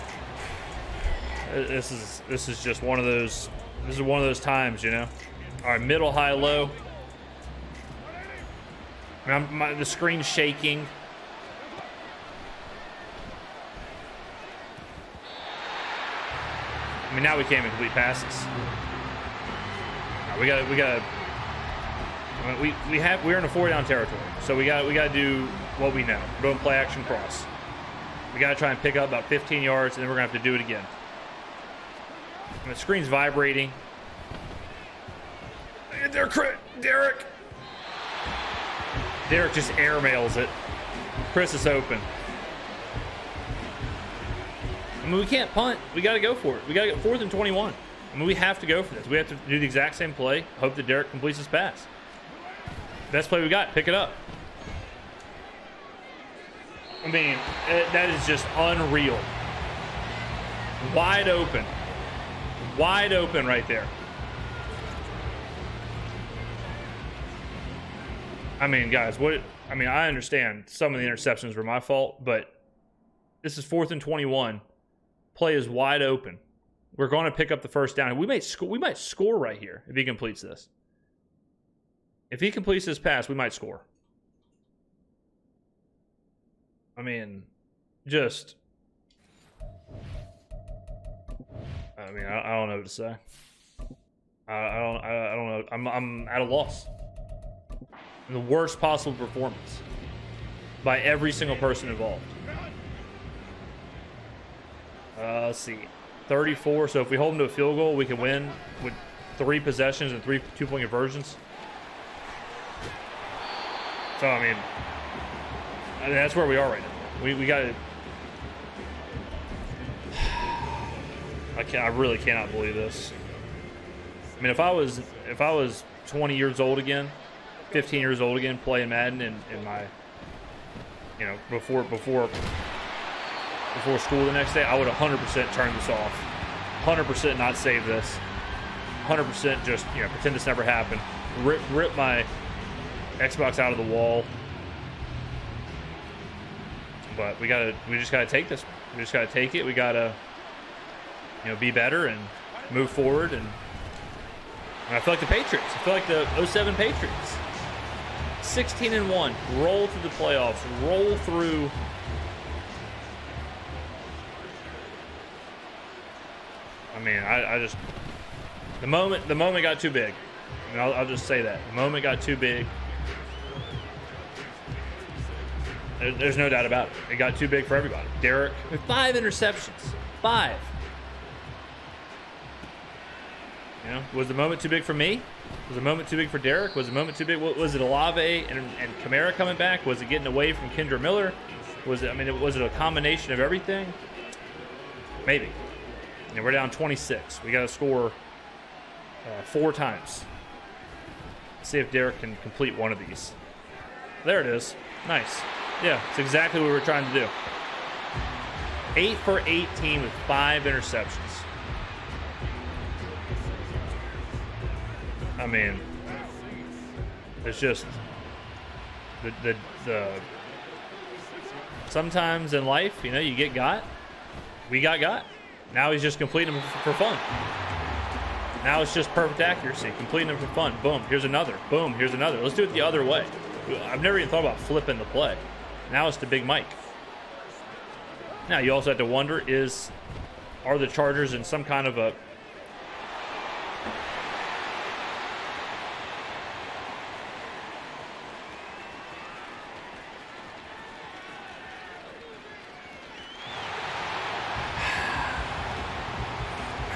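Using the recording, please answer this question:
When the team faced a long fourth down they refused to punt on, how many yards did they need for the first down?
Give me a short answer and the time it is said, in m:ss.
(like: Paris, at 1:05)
21, at 0:46.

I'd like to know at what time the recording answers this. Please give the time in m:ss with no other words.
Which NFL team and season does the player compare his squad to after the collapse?
2:36.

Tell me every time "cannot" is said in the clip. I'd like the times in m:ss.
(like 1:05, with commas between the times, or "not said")
2:02.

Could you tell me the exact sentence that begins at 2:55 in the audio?
There, there's no doubt about it.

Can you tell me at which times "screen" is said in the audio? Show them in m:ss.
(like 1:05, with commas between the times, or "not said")
0:09, 0:32.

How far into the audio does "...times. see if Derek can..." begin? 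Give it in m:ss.
3:19.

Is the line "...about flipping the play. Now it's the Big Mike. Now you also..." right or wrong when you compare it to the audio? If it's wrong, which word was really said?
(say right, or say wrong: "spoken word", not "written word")
right.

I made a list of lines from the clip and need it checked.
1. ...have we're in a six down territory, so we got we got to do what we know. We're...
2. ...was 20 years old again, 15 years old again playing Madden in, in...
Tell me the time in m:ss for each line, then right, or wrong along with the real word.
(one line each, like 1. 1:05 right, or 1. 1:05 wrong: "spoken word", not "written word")
1. 0:22 wrong: "four", not "six"
2. 2:05 right.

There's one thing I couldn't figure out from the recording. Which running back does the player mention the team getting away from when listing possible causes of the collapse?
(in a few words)
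Kendre Miller.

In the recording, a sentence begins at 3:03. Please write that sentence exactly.
You know, was the moment too big for me?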